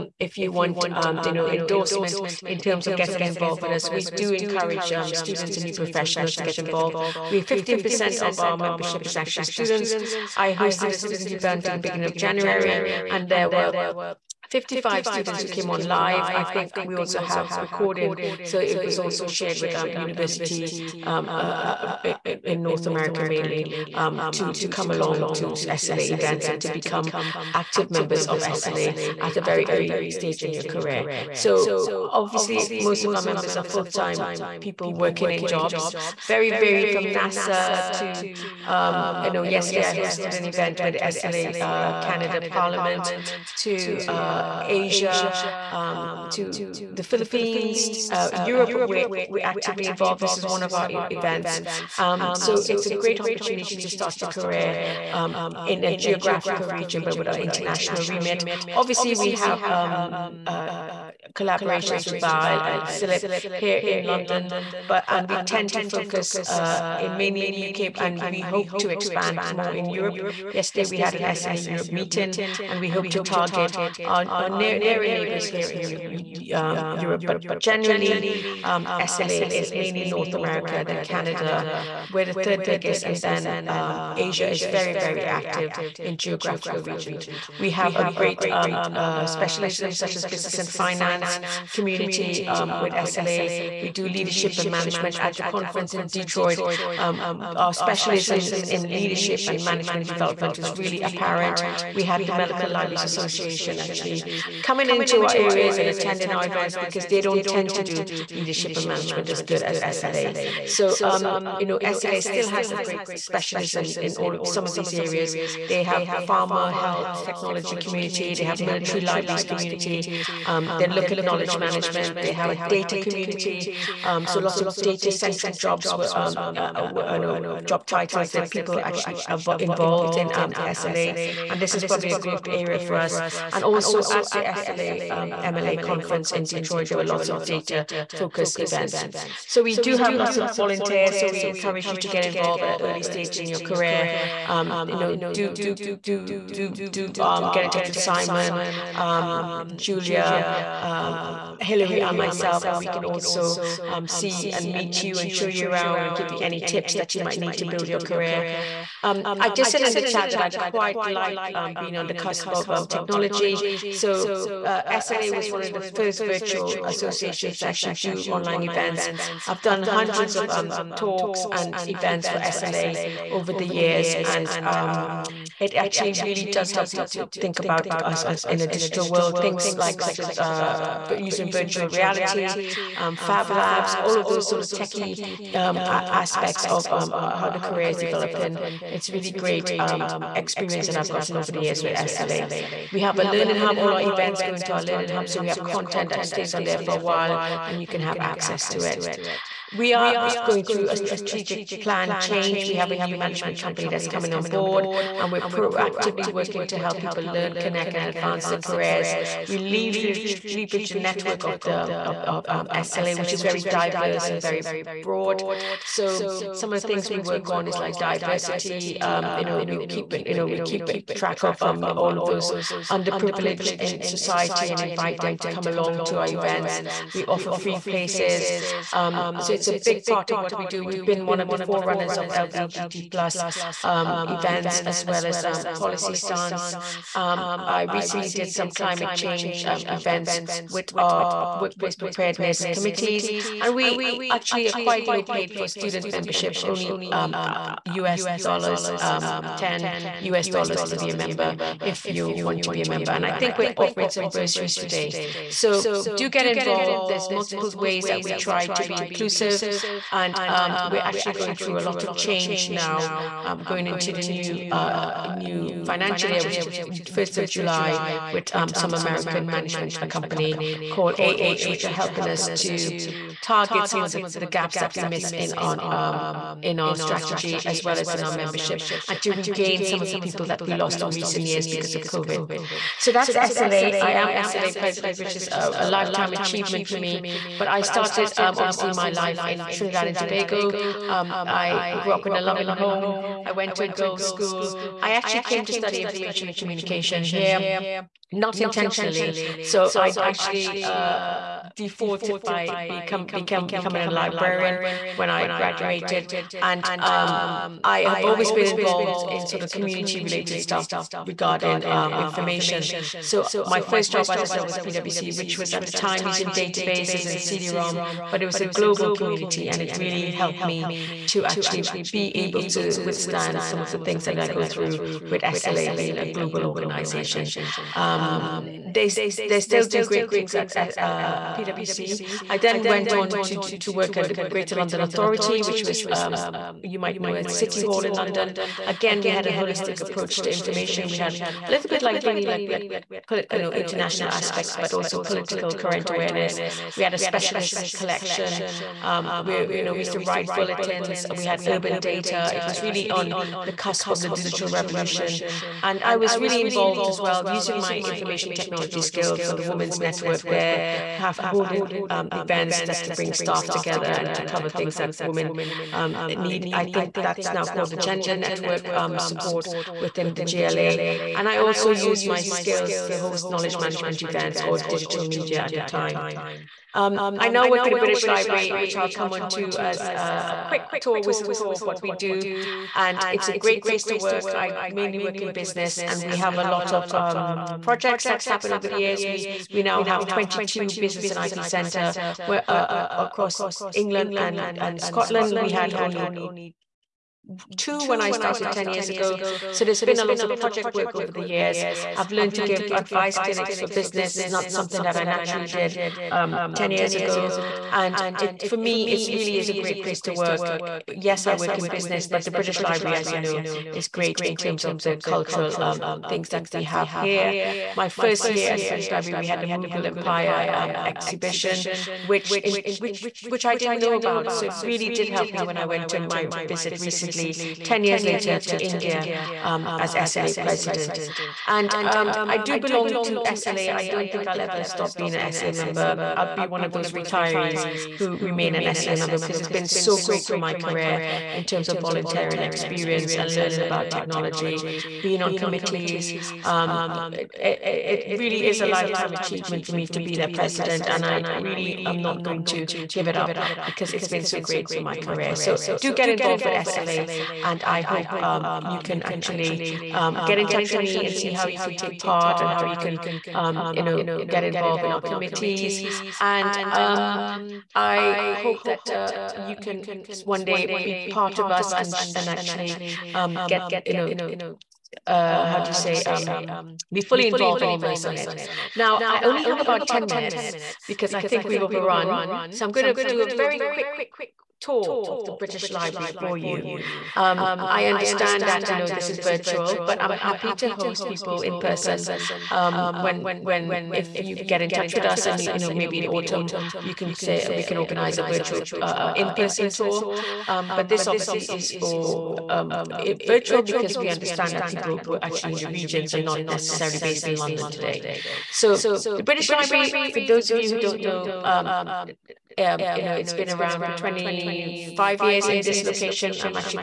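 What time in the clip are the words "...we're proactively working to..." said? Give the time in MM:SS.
03:25.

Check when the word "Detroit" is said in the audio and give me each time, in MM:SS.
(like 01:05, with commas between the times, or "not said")
01:36, 02:16.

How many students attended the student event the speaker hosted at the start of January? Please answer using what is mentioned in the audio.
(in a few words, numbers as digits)
55.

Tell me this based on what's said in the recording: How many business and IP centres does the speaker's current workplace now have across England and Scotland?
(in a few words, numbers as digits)
22.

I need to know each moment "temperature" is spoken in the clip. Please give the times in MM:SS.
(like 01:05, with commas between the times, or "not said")
not said.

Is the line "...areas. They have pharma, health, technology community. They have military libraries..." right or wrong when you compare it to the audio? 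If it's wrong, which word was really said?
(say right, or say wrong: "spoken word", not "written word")
right.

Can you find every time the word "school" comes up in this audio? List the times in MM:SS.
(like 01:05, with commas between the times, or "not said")
04:54.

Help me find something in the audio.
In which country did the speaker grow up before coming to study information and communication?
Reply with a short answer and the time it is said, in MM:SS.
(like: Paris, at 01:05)
Trinidad and Tobago, at 04:49.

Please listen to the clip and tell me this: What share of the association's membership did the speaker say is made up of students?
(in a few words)
15%.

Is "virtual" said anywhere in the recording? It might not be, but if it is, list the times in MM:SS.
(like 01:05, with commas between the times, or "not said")
02:46, 03:01, 08:09, 08:18, 08:23.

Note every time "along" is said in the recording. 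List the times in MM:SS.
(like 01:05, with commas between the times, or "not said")
00:24, 03:45.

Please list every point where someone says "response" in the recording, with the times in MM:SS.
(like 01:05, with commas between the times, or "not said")
not said.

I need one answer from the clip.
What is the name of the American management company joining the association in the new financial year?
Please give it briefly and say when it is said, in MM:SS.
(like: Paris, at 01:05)
AH, at 04:31.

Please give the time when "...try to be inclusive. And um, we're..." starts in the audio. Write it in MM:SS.
04:18.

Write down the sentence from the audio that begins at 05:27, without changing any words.
Um, they they still do great things at, at uh, PwC.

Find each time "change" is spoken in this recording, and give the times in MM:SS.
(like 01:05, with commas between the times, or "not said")
03:22, 03:59, 04:22.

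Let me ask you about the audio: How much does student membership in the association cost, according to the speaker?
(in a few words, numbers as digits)
10 US dollars.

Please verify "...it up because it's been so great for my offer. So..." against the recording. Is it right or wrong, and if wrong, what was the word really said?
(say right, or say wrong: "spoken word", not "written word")
wrong: "career", not "offer".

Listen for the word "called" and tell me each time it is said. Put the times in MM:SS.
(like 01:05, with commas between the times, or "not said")
04:30, 06:07.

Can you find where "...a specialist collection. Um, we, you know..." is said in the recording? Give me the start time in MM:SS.
05:47.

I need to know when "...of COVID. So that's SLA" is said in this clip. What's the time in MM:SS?
04:41.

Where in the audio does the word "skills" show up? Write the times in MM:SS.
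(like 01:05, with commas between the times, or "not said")
05:59, 06:12.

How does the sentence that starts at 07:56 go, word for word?
Um, be fully involved and immersed on it.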